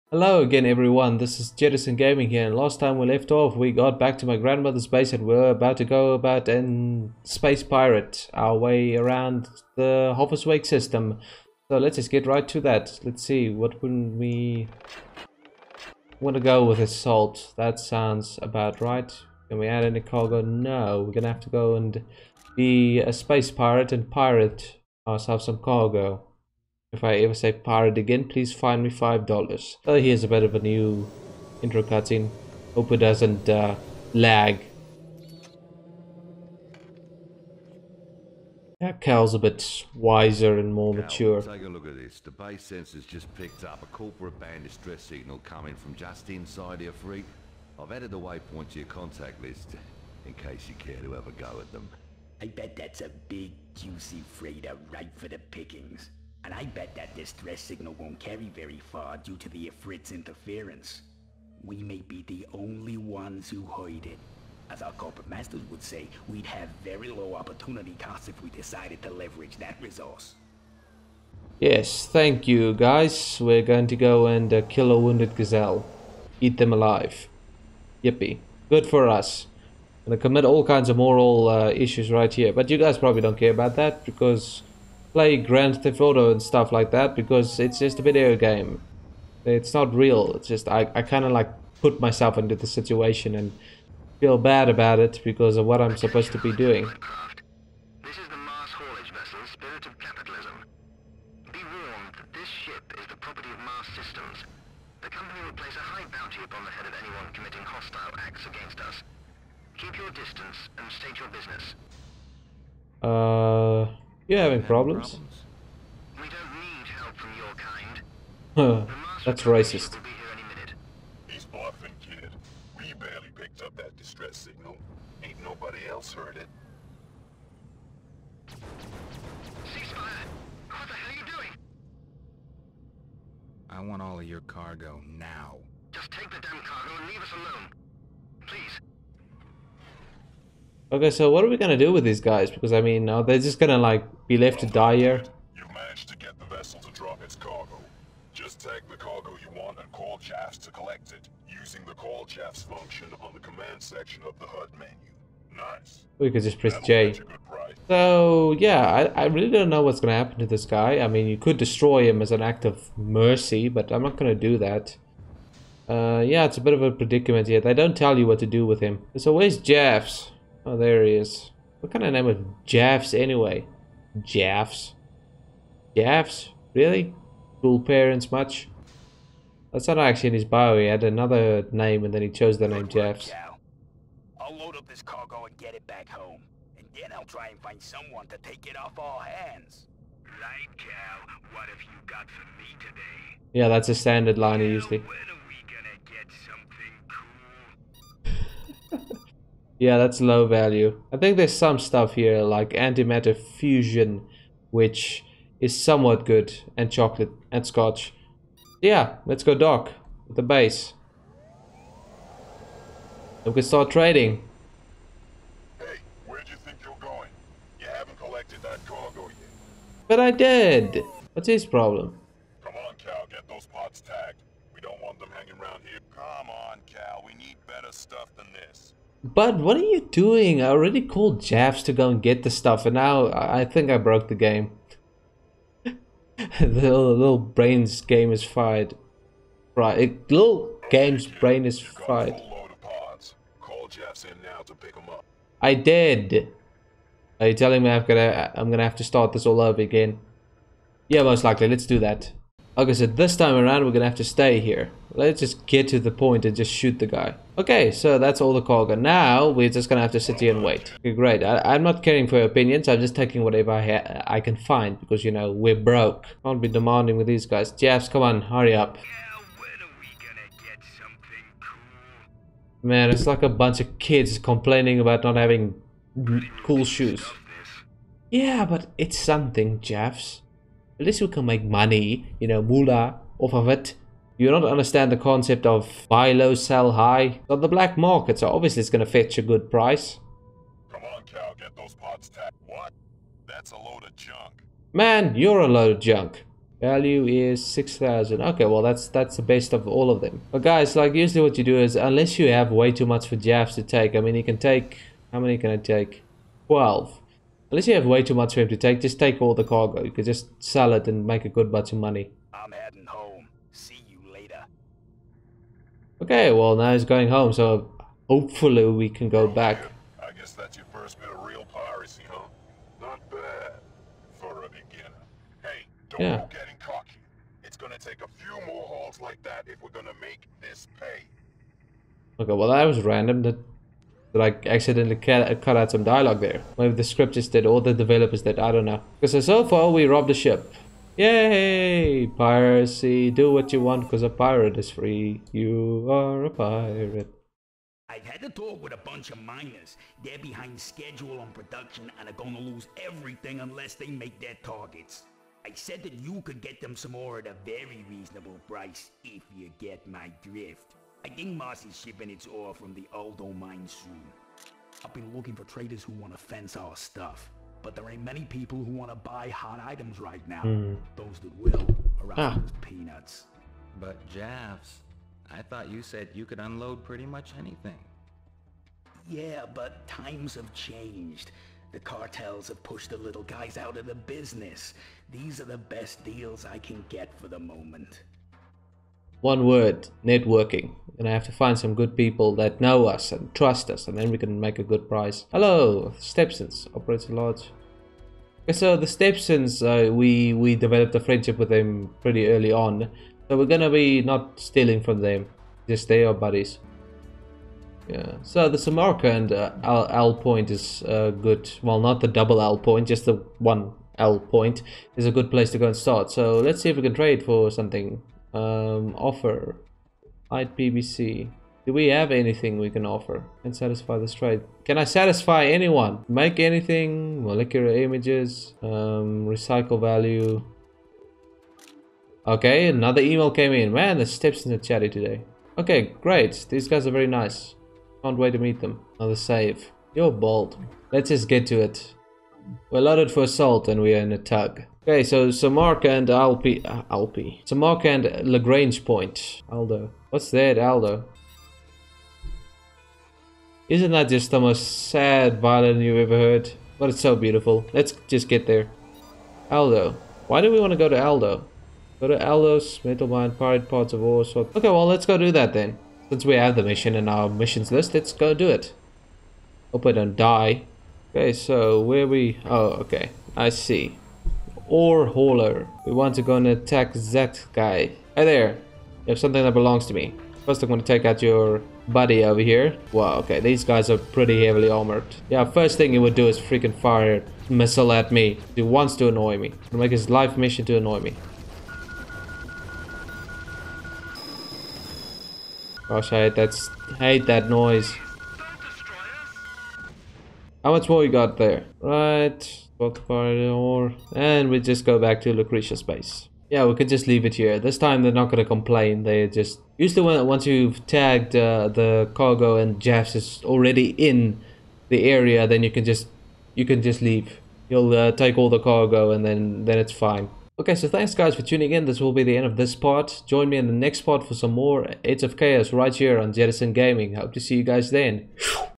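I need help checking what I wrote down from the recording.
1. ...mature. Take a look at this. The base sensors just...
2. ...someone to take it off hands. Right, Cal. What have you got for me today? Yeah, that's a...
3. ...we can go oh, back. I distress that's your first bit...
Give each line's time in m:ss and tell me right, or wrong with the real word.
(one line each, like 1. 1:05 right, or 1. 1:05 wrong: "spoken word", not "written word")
1. 0:41 right
2. 3:07 right
3. 5:18 wrong: "guess", not "distress".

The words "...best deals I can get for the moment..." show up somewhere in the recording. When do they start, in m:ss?
6:25.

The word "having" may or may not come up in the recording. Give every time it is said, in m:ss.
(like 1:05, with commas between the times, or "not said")
1:54, 4:35.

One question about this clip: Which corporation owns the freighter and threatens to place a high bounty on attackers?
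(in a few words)
Mars Systems.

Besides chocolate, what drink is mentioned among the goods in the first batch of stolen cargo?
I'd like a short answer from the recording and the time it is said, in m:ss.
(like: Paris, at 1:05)
Scotch, at 3:27.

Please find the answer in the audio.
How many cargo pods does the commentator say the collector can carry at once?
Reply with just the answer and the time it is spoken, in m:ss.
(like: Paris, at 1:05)
12, at 5:06.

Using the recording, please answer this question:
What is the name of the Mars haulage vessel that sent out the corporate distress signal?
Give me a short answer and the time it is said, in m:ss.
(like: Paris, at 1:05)
Spirit of Capitalism, at 1:39.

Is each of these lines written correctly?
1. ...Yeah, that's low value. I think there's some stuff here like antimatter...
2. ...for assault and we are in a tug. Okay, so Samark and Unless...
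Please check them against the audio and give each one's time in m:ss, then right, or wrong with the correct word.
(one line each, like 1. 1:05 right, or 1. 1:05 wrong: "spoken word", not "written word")
1. 3:19 right
2. 7:23 wrong: "Alpi", not "Unless".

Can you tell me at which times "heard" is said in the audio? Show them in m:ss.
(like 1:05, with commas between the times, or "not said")
1:03, 2:06, 7:36.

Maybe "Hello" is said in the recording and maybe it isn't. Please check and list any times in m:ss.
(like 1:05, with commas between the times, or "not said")
0:00, 6:35.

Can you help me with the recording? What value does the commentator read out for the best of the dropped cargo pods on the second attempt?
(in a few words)
6000.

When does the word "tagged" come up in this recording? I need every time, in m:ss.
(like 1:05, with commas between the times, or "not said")
3:44, 4:52, 8:31.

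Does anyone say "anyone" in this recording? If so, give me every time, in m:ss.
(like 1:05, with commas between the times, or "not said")
1:47, 7:05.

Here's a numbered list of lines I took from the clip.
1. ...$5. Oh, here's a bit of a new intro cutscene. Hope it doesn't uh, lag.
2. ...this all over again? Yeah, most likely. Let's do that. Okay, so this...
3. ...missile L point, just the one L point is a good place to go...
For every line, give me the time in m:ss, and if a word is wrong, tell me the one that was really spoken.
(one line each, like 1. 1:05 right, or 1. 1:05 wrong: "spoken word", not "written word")
1. 0:28 right
2. 4:09 right
3. 6:52 wrong: "double", not "missile".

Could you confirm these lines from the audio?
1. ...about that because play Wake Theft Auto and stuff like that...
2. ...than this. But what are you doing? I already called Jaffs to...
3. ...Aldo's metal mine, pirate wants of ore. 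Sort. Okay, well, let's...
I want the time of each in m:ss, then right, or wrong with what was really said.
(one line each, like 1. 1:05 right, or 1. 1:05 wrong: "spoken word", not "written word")
1. 1:23 wrong: "Grand", not "Wake"
2. 3:48 right
3. 7:42 wrong: "parts", not "wants".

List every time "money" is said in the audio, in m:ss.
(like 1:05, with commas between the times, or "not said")
4:41, 5:11.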